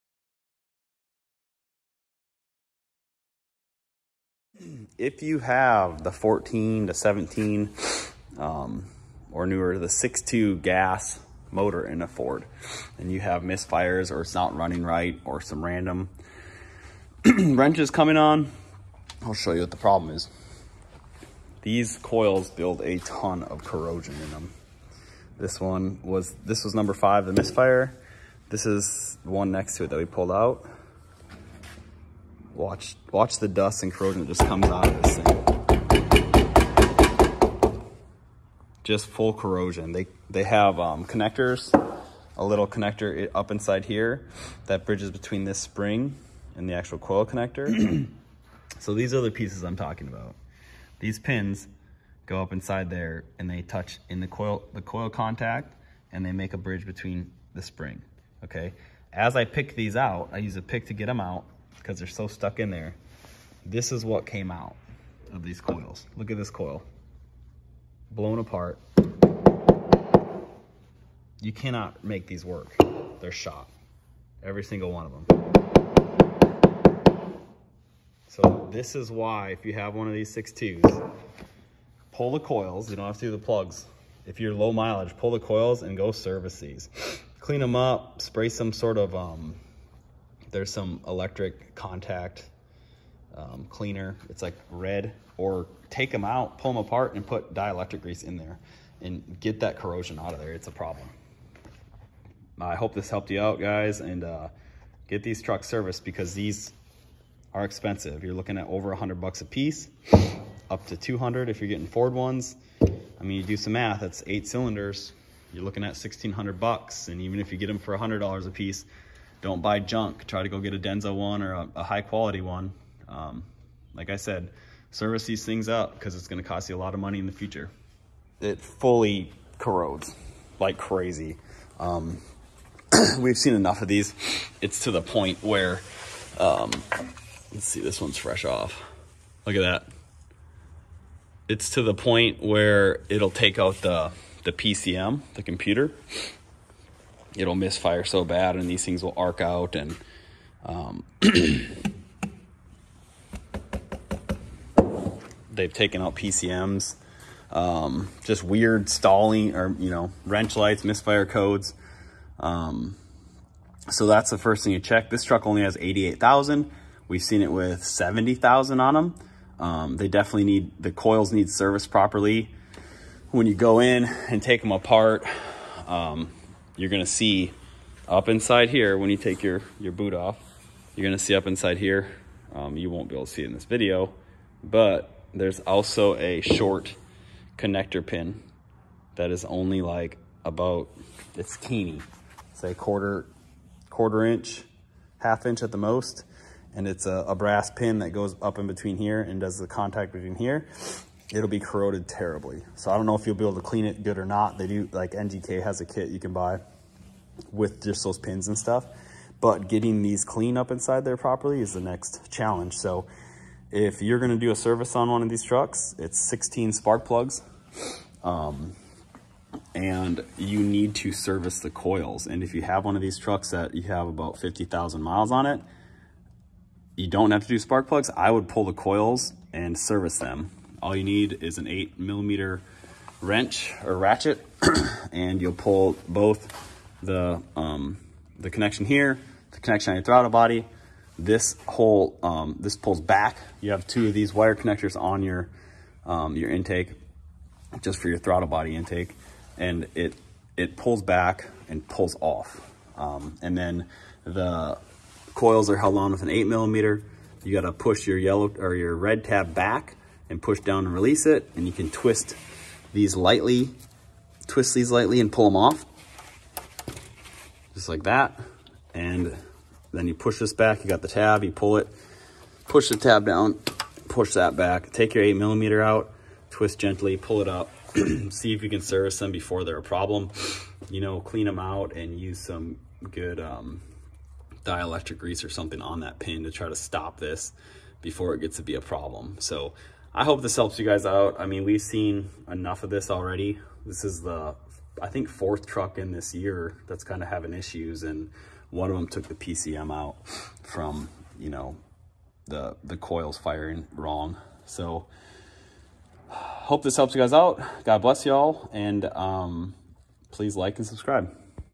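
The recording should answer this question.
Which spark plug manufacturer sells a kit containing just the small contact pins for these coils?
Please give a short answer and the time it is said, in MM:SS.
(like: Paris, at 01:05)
NGK, at 03:25.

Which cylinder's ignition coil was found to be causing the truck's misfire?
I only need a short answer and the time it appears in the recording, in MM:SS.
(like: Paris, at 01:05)
5, at 00:26.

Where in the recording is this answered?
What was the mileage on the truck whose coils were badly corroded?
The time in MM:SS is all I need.
02:45.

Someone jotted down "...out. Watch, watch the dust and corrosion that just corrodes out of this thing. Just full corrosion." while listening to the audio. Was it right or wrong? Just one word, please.
wrong.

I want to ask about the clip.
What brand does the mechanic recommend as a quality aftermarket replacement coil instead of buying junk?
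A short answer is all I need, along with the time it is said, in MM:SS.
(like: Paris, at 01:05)
Denso, at 02:00.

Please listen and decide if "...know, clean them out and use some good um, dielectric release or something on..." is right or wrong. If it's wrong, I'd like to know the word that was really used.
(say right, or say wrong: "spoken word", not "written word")
wrong: "grease", not "release".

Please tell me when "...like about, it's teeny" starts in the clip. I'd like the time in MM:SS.
03:09.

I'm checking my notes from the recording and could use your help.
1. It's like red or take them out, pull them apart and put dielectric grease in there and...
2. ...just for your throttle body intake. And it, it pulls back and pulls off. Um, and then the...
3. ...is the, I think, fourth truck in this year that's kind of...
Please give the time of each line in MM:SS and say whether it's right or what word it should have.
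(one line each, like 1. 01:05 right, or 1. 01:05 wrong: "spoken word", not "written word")
1. 01:34 right
2. 04:07 right
3. 04:54 right.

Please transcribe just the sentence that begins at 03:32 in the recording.
So if you're gonna do a service on one of these trucks, it's 16 spark plugs.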